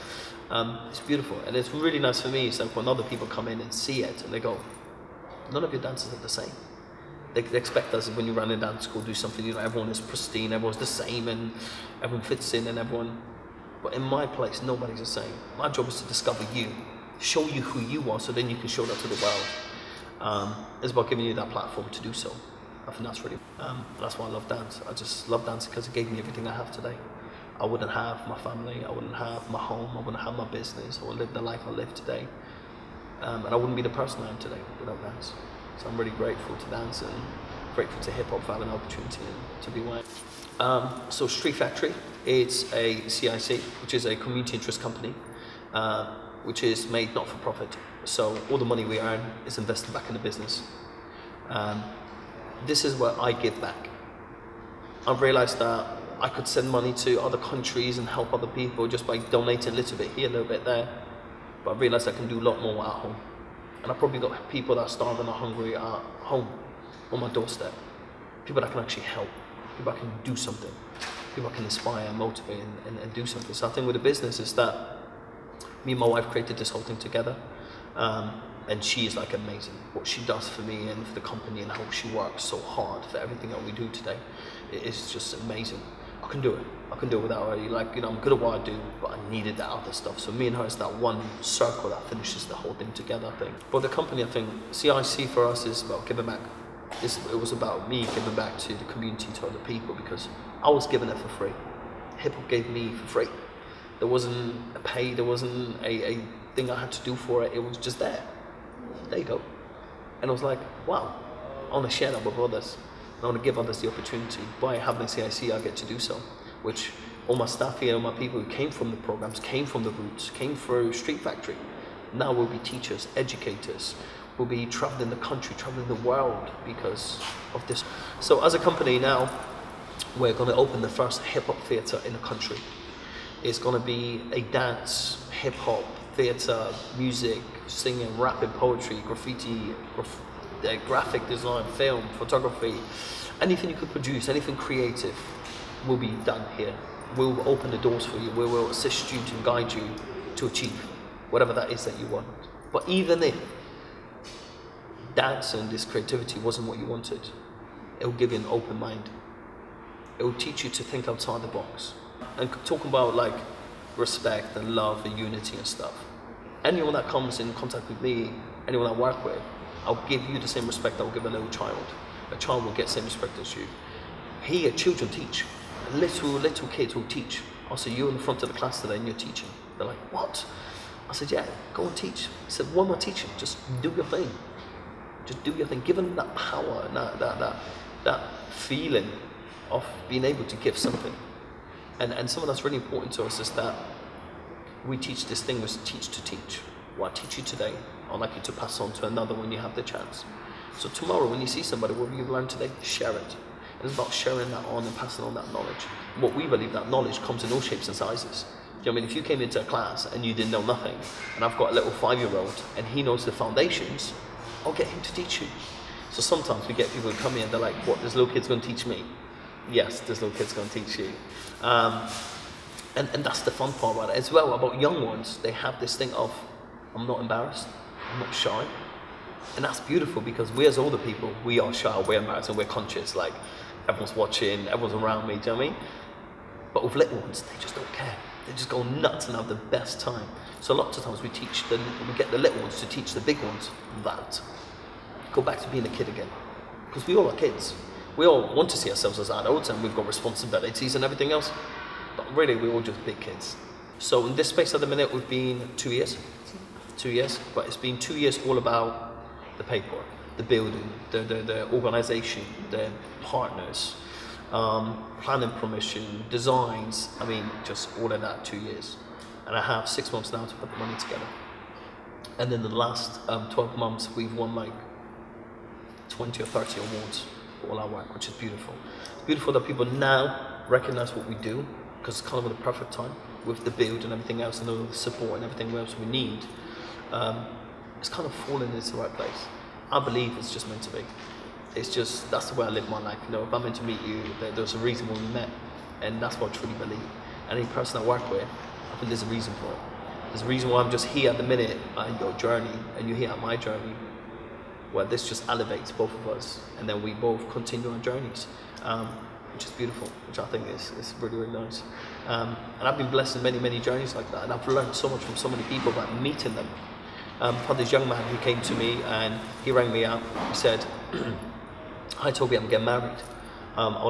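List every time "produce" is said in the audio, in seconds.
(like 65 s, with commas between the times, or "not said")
143 s.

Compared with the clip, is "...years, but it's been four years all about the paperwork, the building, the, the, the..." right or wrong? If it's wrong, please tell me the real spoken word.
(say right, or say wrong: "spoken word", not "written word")
wrong: "two", not "four".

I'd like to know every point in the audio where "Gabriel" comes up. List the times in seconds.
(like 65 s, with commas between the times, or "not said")
not said.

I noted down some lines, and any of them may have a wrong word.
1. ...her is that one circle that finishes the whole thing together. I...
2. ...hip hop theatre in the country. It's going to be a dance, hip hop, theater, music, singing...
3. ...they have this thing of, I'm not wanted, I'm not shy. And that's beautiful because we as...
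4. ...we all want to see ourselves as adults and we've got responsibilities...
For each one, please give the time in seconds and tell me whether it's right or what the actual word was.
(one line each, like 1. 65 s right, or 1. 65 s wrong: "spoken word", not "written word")
1. 90 s right
2. 131 s right
3. 225 s wrong: "embarrassed", not "wanted"
4. 248 s right.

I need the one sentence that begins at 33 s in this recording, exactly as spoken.
Um, and I wouldn't be the person I am today without dance.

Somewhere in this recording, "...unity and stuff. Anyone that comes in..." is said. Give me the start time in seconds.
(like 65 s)
165 s.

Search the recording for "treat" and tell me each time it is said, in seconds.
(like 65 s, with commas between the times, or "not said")
not said.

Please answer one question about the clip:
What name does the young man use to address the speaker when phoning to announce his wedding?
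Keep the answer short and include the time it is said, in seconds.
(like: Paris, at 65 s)
Toby, at 322 s.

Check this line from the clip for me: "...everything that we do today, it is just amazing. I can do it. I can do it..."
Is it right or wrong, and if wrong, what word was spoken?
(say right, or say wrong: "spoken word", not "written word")
right.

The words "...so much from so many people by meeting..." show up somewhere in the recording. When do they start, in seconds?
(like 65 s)
314 s.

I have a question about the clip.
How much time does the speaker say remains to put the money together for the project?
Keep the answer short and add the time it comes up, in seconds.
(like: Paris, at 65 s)
6 months, at 269 s.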